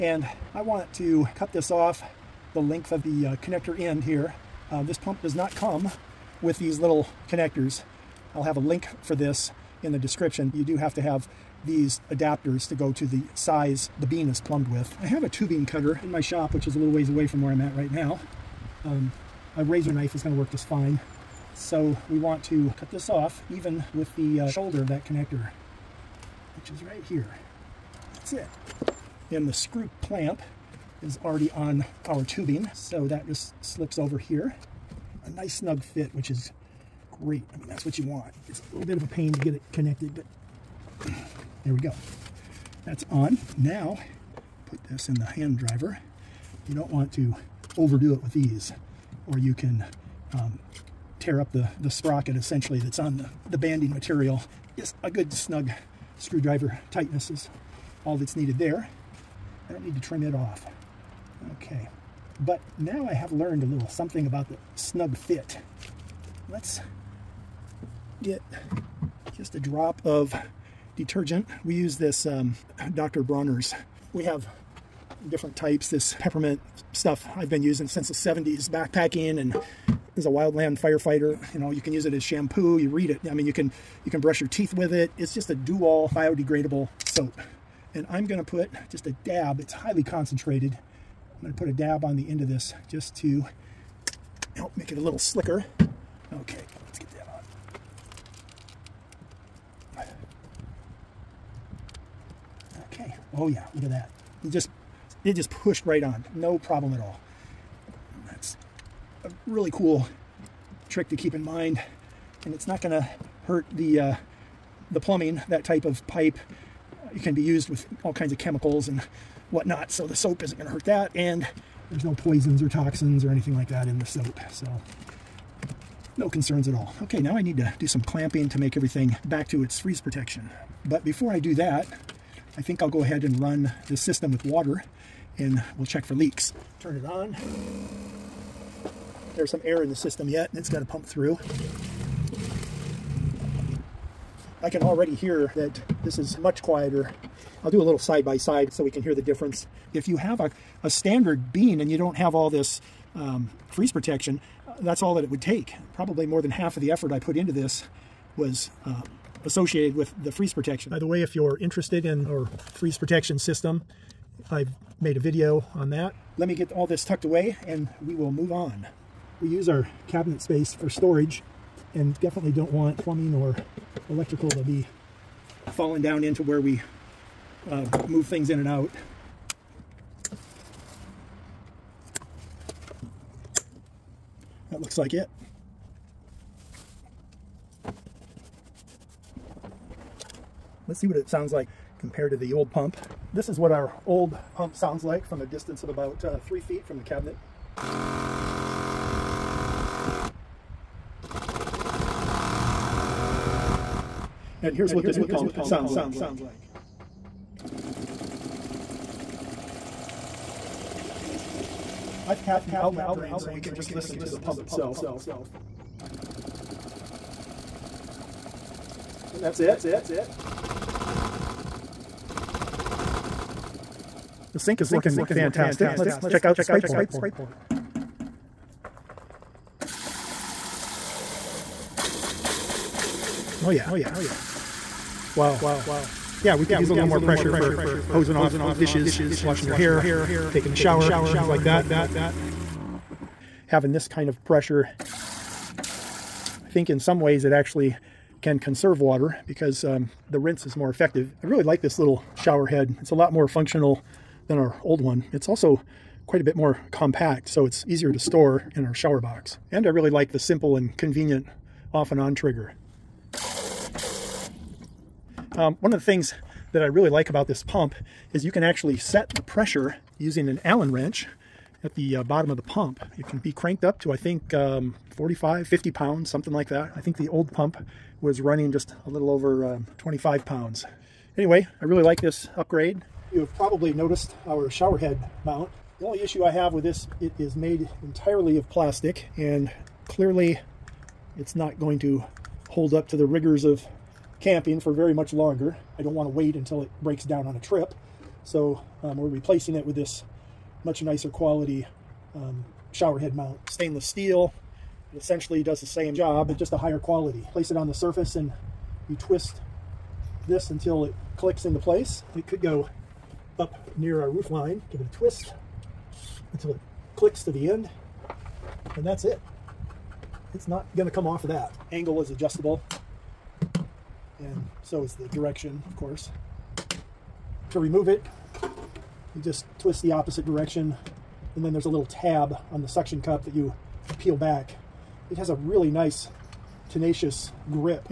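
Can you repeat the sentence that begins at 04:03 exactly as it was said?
Having this kind of pressure think in some ways it actually can conserve water because um, the rinse is more effective.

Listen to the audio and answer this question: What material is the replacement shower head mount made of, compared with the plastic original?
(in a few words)
Stainless steel.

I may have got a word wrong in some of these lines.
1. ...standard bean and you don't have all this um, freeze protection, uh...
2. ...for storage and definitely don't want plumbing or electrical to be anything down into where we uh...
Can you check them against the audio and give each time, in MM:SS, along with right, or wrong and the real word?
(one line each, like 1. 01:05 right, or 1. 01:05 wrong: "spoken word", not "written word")
1. 02:30 right
2. 02:50 wrong: "falling", not "anything".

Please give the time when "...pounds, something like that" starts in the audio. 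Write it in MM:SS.
04:35.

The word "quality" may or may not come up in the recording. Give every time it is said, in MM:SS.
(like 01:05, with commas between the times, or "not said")
05:01, 05:06.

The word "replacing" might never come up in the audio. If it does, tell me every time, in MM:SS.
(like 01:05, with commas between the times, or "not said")
04:59.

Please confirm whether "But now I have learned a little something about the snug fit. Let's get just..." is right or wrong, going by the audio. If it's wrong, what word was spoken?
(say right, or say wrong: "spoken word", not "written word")
right.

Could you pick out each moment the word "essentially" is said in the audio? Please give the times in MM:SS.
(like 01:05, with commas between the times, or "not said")
00:52, 05:05.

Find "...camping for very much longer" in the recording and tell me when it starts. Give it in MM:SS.
04:54.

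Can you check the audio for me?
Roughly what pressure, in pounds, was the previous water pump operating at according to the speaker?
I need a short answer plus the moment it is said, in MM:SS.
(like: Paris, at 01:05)
25 pounds, at 04:39.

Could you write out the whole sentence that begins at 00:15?
I have a tubing cutter in my shop, which is a little ways away from where I'm at right now.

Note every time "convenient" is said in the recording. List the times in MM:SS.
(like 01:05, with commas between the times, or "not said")
04:20.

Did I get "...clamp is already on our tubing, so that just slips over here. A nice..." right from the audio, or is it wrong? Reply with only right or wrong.
right.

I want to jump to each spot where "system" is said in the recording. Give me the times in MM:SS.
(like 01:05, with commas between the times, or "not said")
02:13, 02:19, 02:43.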